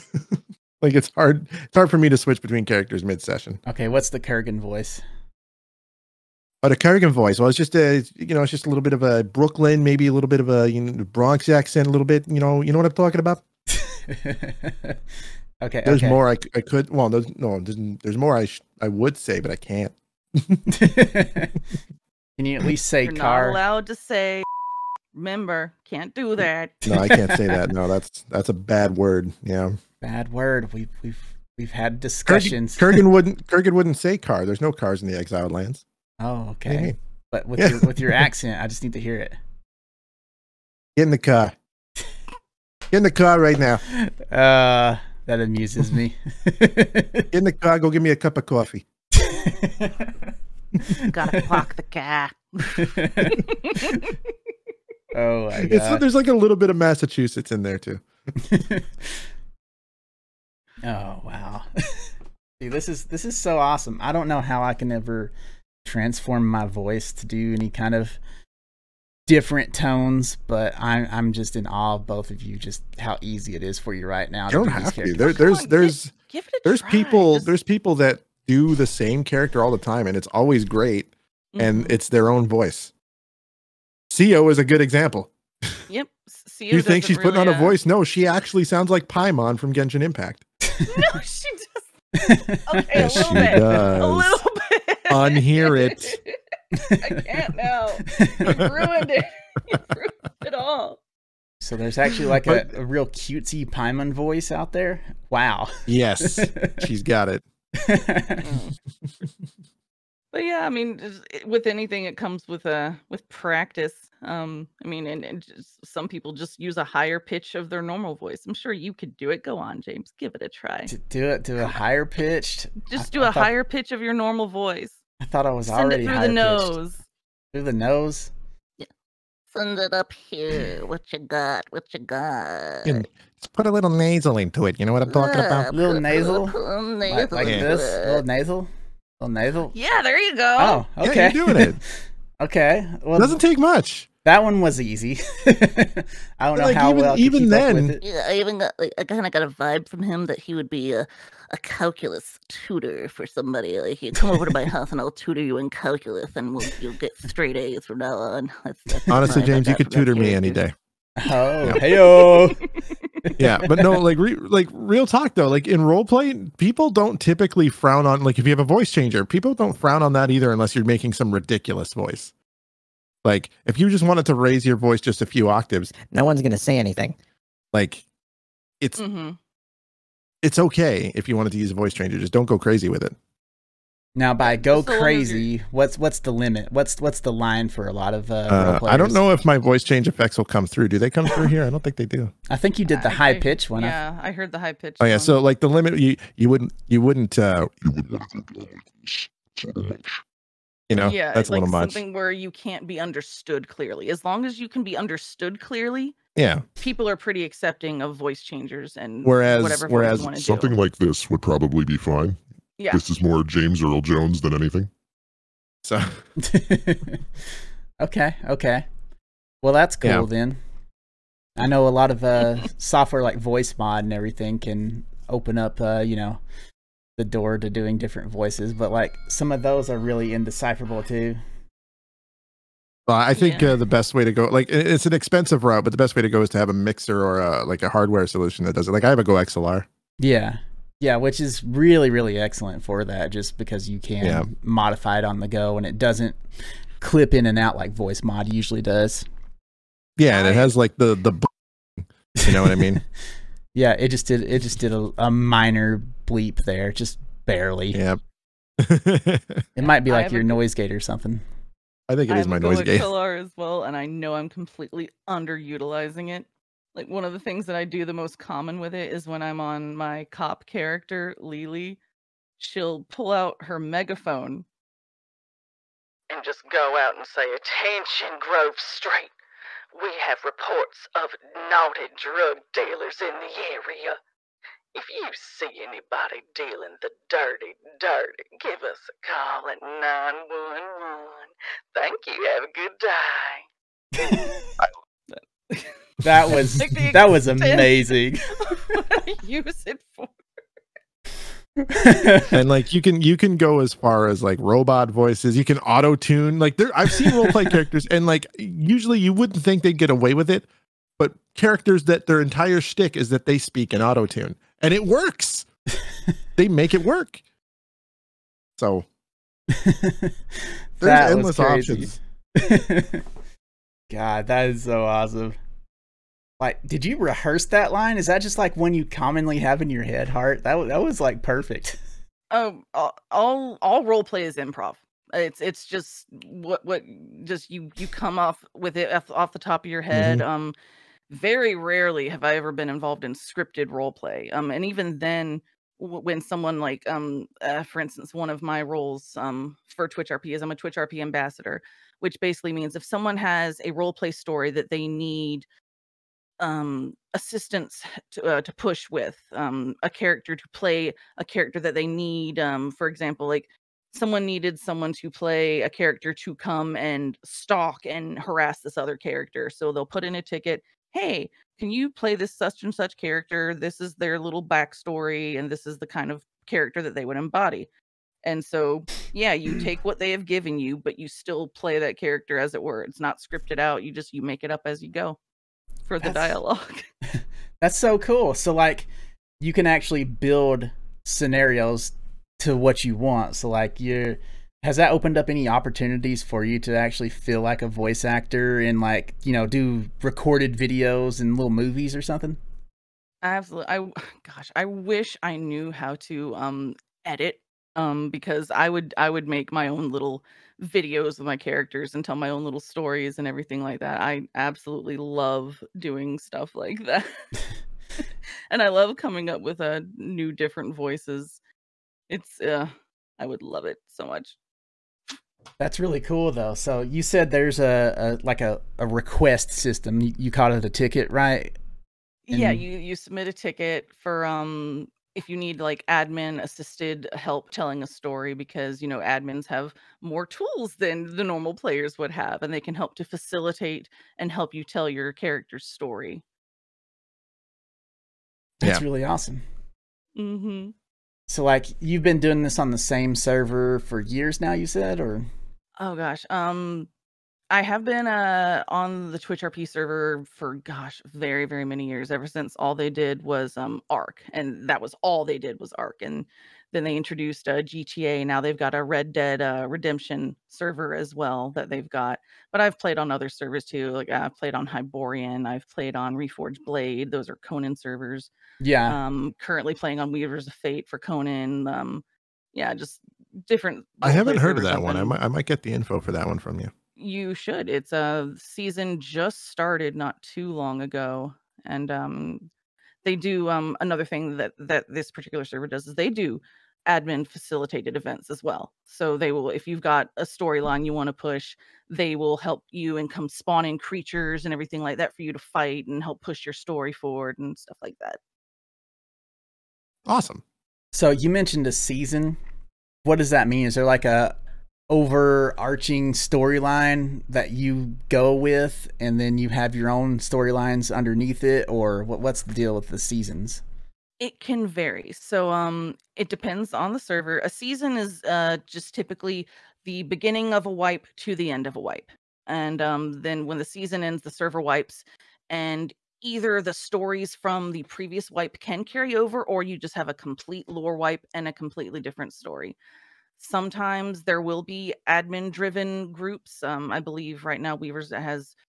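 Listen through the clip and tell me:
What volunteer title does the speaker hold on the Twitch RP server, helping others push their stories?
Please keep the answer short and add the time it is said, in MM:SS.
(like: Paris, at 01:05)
Twitch RP ambassador, at 05:50.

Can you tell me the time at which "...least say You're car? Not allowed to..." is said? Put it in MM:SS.
00:22.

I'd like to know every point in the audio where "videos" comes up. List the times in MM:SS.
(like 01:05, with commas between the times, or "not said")
06:40, 06:50.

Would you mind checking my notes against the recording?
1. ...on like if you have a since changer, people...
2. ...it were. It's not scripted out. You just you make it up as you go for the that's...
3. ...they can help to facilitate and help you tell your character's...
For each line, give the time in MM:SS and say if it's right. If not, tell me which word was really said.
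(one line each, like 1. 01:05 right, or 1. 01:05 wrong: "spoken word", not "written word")
1. 02:48 wrong: "voice", not "since"
2. 06:22 right
3. 07:22 right.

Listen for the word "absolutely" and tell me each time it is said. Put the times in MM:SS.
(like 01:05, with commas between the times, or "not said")
06:43, 06:54.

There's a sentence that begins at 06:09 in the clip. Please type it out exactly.
So they'll put in a ticket hey, can you play this such and such character?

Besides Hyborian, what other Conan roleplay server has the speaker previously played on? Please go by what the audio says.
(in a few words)
Reforged Blade.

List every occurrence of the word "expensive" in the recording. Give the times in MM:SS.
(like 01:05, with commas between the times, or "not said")
03:55.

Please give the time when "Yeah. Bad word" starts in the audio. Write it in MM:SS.
00:29.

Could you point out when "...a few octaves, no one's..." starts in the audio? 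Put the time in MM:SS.
02:55.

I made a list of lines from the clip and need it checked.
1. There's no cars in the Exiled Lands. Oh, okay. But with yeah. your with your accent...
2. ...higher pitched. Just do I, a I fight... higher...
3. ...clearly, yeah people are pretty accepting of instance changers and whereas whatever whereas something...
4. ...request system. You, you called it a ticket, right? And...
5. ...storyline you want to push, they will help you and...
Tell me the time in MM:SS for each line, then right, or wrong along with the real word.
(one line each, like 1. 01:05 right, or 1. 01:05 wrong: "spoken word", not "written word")
1. 00:34 right
2. 02:01 wrong: "thought", not "fight"
3. 03:25 wrong: "voice", not "instance"
4. 07:09 right
5. 08:20 right.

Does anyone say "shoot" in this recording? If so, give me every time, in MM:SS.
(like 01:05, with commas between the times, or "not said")
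not said.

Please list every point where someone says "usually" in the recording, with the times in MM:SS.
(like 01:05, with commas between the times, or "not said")
04:08, 05:08.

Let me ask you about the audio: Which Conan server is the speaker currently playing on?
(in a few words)
Weavers of Fate.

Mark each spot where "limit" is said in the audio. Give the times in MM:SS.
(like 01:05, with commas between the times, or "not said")
03:06, 03:15.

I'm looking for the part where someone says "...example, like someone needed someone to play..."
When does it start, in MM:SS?
06:03.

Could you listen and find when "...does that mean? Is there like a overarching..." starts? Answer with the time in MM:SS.
08:33.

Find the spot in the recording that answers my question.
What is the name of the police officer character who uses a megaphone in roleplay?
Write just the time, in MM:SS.
04:31.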